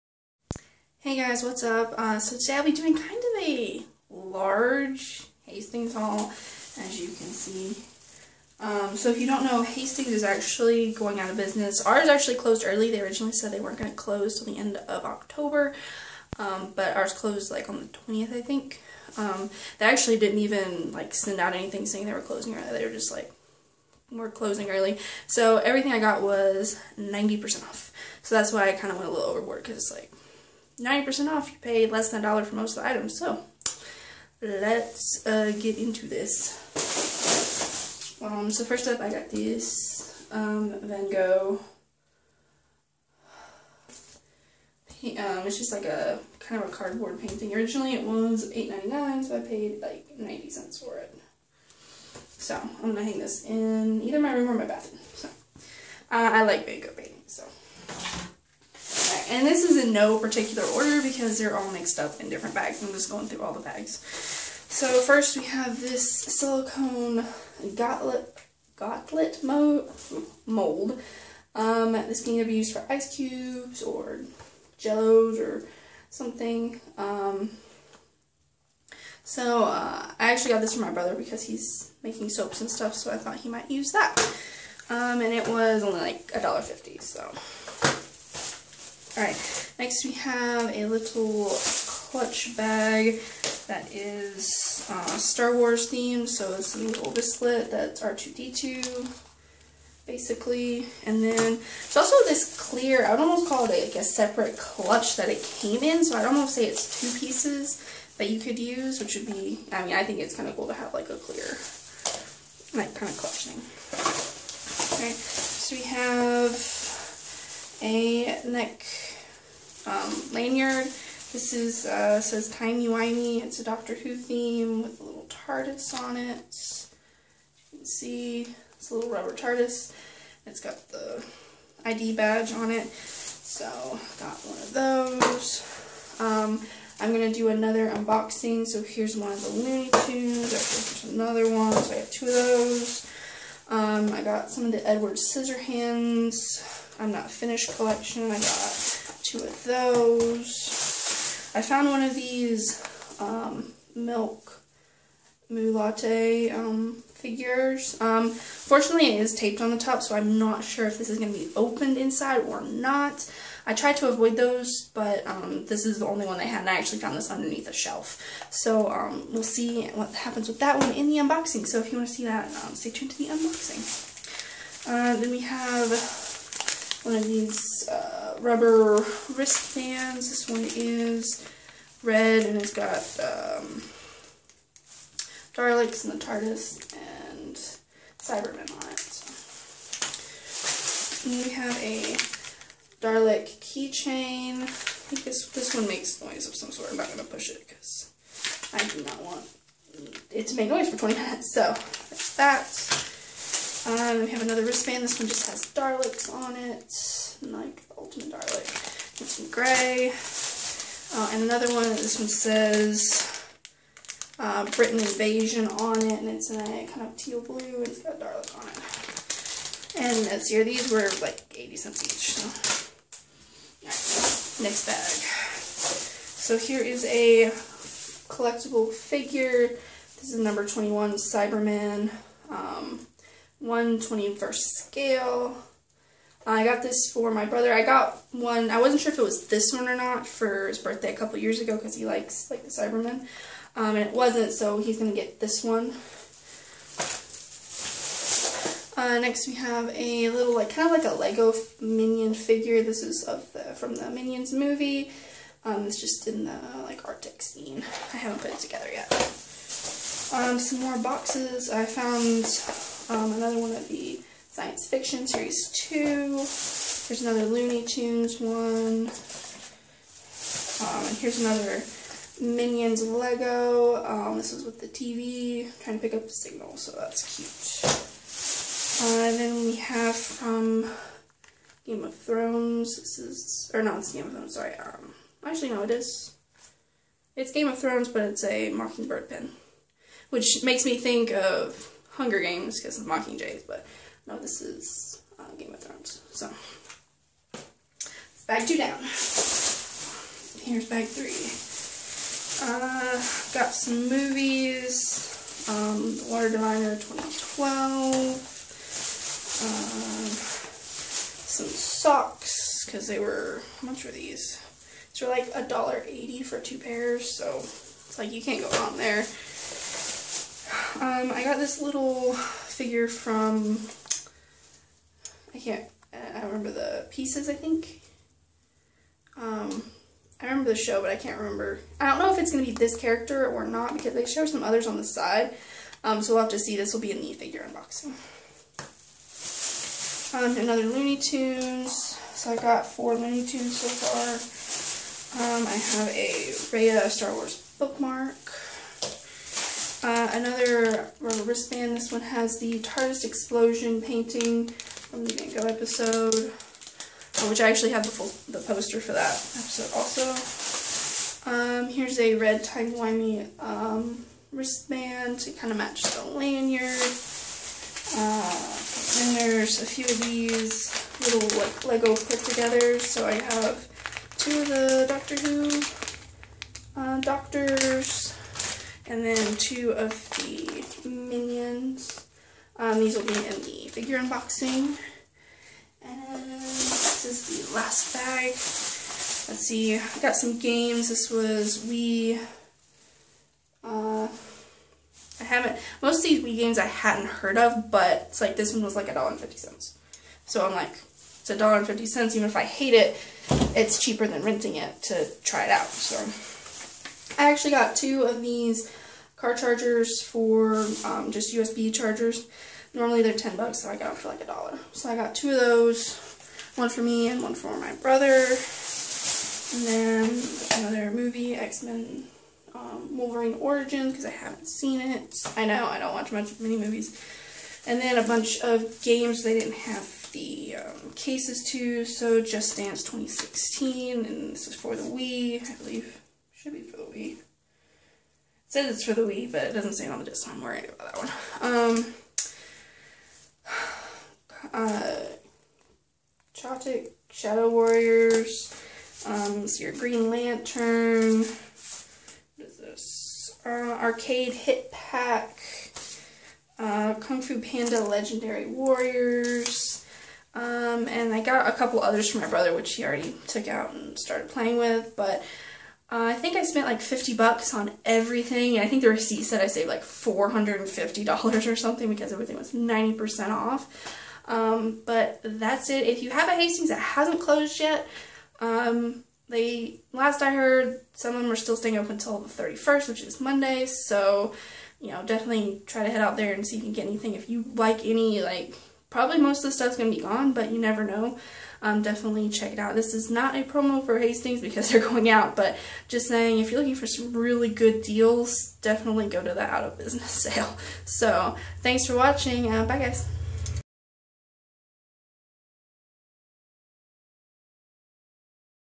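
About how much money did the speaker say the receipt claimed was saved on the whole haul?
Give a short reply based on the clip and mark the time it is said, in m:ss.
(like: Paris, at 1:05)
$450, at 7:50.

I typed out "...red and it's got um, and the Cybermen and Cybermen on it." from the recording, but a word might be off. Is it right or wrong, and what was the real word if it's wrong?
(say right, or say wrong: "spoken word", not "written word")
wrong: "TARDIS", not "Cybermen".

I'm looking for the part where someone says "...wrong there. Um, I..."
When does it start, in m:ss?
5:18.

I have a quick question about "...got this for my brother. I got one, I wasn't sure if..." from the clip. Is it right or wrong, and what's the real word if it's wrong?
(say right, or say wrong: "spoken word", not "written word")
right.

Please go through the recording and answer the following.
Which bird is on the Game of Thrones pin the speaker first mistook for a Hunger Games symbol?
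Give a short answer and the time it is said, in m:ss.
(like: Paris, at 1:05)
Mockingbird, at 4:48.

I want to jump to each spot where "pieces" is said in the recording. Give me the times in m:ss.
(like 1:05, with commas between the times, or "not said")
1:47, 5:27.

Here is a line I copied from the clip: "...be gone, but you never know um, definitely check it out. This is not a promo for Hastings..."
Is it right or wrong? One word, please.
right.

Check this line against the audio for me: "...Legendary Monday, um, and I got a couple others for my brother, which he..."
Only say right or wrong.
wrong.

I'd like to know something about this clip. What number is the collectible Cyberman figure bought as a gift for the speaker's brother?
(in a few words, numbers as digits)
21.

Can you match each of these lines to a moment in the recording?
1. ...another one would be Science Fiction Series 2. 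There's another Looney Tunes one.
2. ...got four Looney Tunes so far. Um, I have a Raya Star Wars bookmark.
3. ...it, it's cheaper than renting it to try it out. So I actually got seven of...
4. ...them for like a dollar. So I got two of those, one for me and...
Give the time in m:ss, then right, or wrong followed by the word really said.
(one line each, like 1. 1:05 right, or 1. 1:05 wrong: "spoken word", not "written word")
1. 4:23 right
2. 5:42 right
3. 6:42 wrong: "two", not "seven"
4. 6:54 right.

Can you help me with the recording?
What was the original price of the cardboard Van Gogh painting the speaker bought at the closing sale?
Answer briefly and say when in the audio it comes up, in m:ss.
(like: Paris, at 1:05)
$8.99, at 0:48.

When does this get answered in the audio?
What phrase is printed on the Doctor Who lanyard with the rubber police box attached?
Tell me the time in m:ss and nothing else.
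2:02.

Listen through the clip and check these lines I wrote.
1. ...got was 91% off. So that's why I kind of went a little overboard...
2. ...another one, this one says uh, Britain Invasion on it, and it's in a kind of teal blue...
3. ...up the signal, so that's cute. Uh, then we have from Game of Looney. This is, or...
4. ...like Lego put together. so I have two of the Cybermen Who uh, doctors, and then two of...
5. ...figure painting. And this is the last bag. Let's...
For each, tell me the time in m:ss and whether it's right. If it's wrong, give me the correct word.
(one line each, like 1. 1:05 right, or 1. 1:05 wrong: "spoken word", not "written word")
1. 0:25 wrong: "90", not "91"
2. 3:31 right
3. 4:36 wrong: "Thrones", not "Looney"
4. 6:11 wrong: "Doctor", not "Cybermen"
5. 6:23 wrong: "unboxing", not "painting".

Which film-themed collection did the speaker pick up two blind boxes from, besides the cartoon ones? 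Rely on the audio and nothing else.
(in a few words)
Edward Scissorhands.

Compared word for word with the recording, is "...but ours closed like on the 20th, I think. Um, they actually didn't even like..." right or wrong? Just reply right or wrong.
right.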